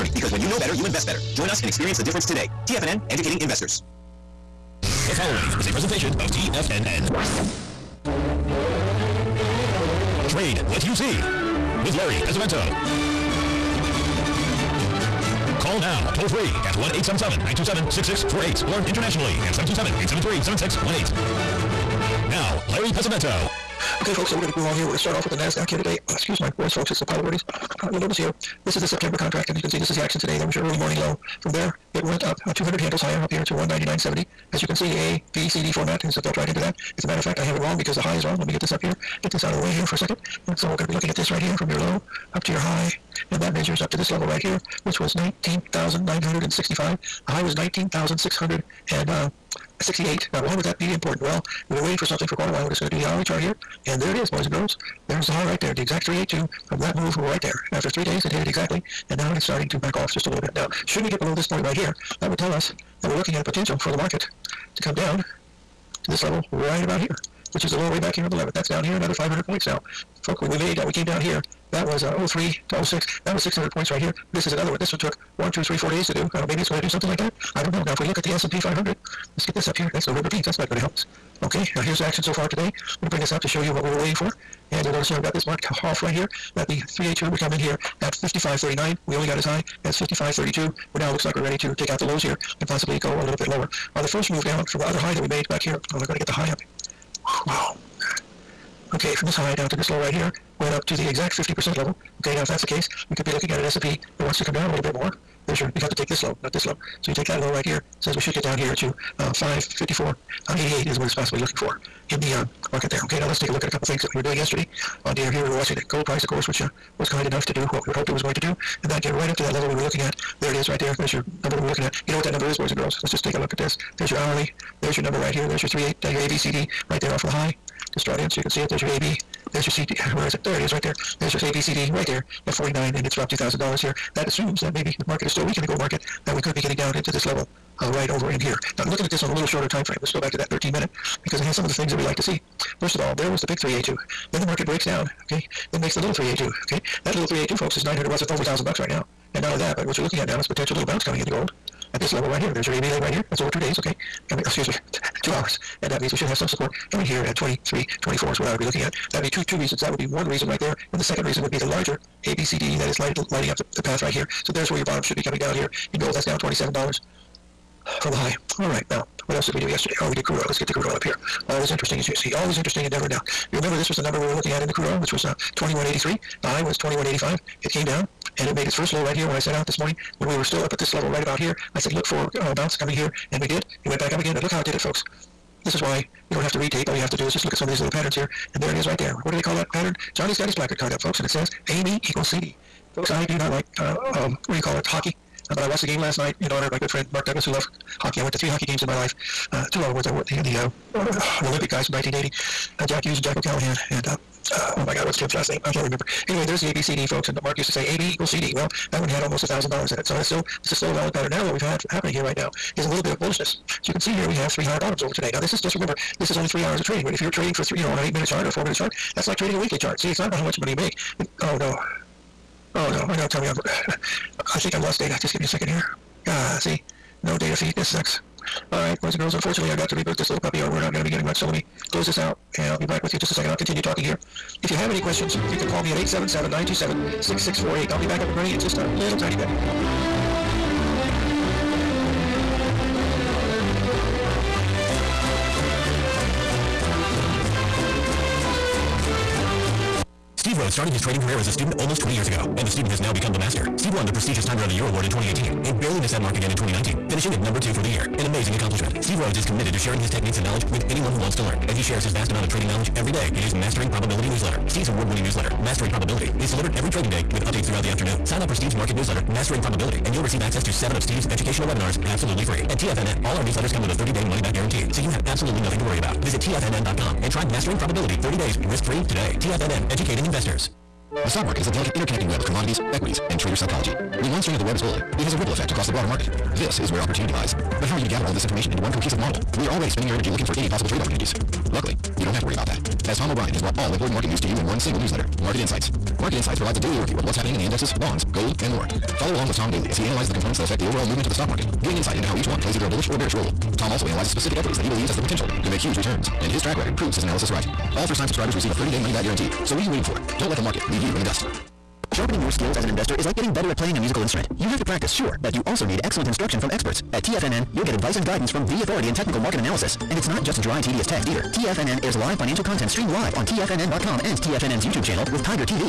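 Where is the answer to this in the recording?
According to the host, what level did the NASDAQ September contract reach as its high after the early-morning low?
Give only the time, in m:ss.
0:47.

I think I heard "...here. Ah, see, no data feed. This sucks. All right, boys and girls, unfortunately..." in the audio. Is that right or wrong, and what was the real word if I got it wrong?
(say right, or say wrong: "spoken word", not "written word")
right.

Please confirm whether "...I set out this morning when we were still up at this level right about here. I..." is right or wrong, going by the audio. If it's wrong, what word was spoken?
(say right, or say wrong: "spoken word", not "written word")
right.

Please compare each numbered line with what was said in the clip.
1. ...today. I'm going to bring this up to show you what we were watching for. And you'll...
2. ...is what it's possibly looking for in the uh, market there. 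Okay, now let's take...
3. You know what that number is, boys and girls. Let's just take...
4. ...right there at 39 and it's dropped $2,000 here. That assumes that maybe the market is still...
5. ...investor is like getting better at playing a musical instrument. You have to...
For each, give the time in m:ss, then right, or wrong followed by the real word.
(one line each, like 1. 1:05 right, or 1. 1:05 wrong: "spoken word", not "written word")
1. 1:22 wrong: "waiting", not "watching"
2. 1:50 right
3. 2:02 right
4. 2:11 wrong: "49", not "39"
5. 5:12 right.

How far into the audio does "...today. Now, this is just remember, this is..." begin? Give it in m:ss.
3:35.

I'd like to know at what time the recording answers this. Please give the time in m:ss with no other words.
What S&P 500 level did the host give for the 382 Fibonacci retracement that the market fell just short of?
1:28.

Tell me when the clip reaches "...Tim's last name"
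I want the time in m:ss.
3:25.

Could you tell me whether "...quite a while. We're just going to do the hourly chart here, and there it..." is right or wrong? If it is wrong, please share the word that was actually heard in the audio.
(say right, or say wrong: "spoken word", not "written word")
right.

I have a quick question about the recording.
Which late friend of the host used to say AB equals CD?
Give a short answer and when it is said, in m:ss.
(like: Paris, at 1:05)
Mark Douglas, at 3:17.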